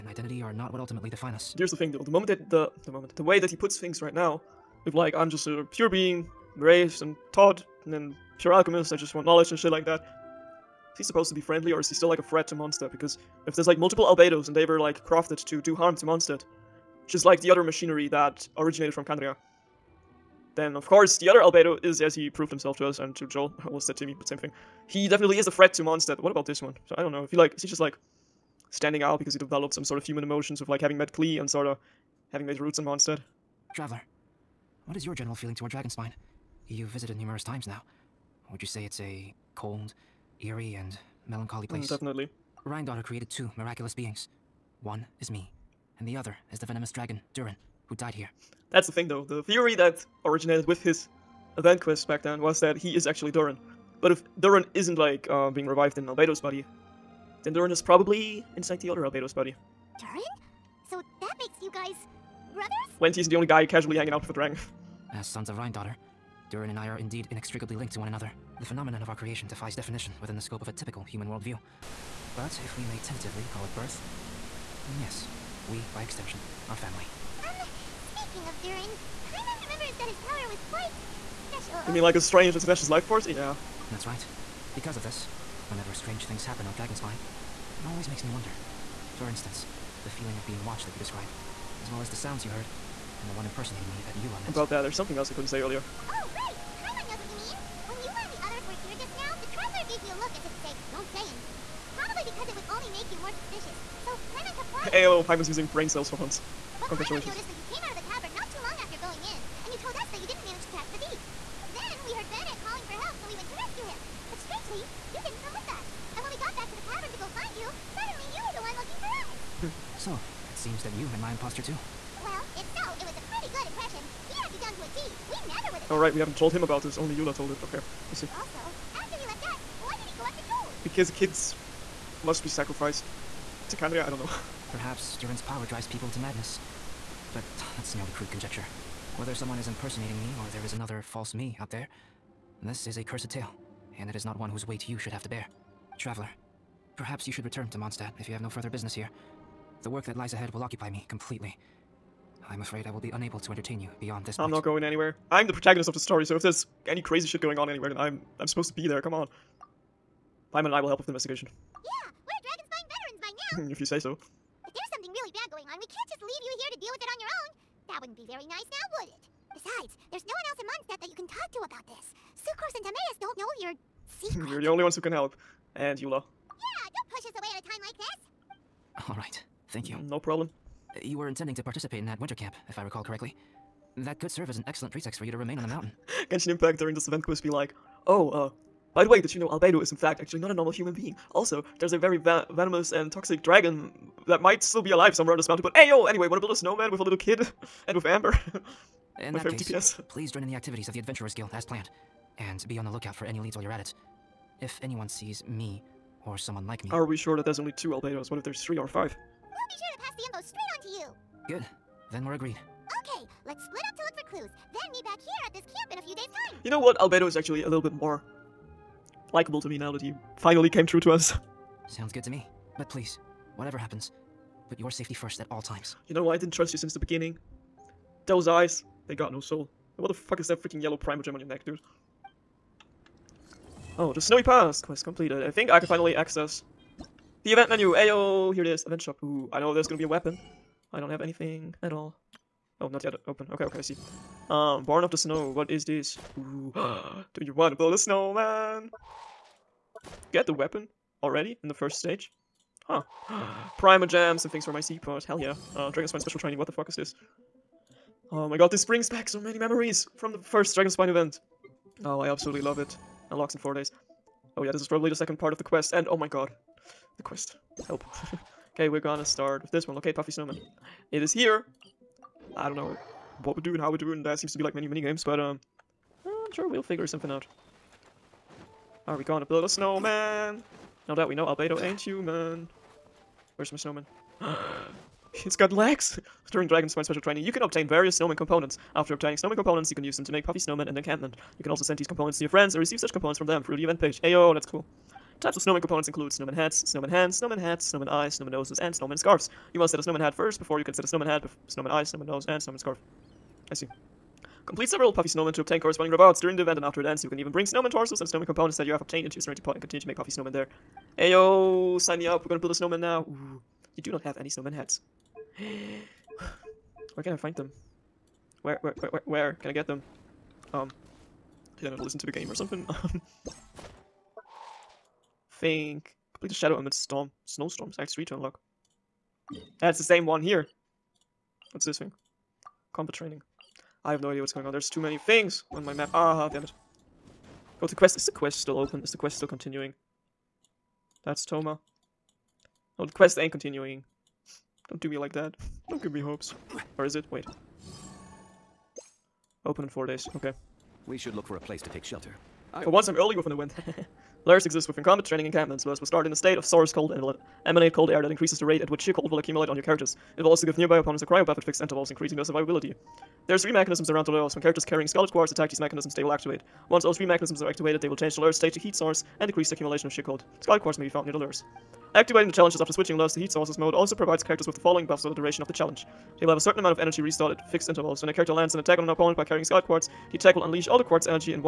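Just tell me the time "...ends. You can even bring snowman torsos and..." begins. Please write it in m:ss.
5:07.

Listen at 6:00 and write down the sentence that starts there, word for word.
It will also give nearby opponents a cryo buff at fixed intervals, increasing their survivability.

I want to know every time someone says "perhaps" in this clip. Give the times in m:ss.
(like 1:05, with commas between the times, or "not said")
2:14, 2:26.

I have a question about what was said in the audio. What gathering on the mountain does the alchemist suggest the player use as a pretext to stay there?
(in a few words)
winter camp.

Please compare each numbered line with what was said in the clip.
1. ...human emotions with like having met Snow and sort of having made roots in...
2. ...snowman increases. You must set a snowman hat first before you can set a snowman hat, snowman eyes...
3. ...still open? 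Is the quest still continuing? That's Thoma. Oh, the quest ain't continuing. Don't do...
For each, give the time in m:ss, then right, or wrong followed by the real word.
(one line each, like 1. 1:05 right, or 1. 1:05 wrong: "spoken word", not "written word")
1. 0:30 wrong: "Klee", not "Snow"
2. 4:58 wrong: "scarves", not "increases"
3. 5:38 right.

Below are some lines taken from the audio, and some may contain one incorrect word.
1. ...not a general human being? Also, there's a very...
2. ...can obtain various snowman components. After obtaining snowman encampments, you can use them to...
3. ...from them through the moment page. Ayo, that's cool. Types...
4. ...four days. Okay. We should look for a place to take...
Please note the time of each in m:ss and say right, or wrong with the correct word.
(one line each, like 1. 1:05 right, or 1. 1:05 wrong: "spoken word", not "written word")
1. 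3:10 wrong: "normal", not "general"
2. 4:47 wrong: "components", not "encampments"
3. 4:53 wrong: "event", not "moment"
4. 5:49 right.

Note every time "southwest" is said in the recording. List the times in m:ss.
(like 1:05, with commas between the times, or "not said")
not said.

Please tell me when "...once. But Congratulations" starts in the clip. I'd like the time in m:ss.
1:46.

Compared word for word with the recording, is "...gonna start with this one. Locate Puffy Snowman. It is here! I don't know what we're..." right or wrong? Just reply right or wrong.
right.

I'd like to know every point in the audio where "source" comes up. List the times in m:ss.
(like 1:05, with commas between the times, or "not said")
5:56, 6:08, 6:13.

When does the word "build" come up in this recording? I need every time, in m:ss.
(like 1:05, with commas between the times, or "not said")
3:16, 4:07, 4:39, 5:12.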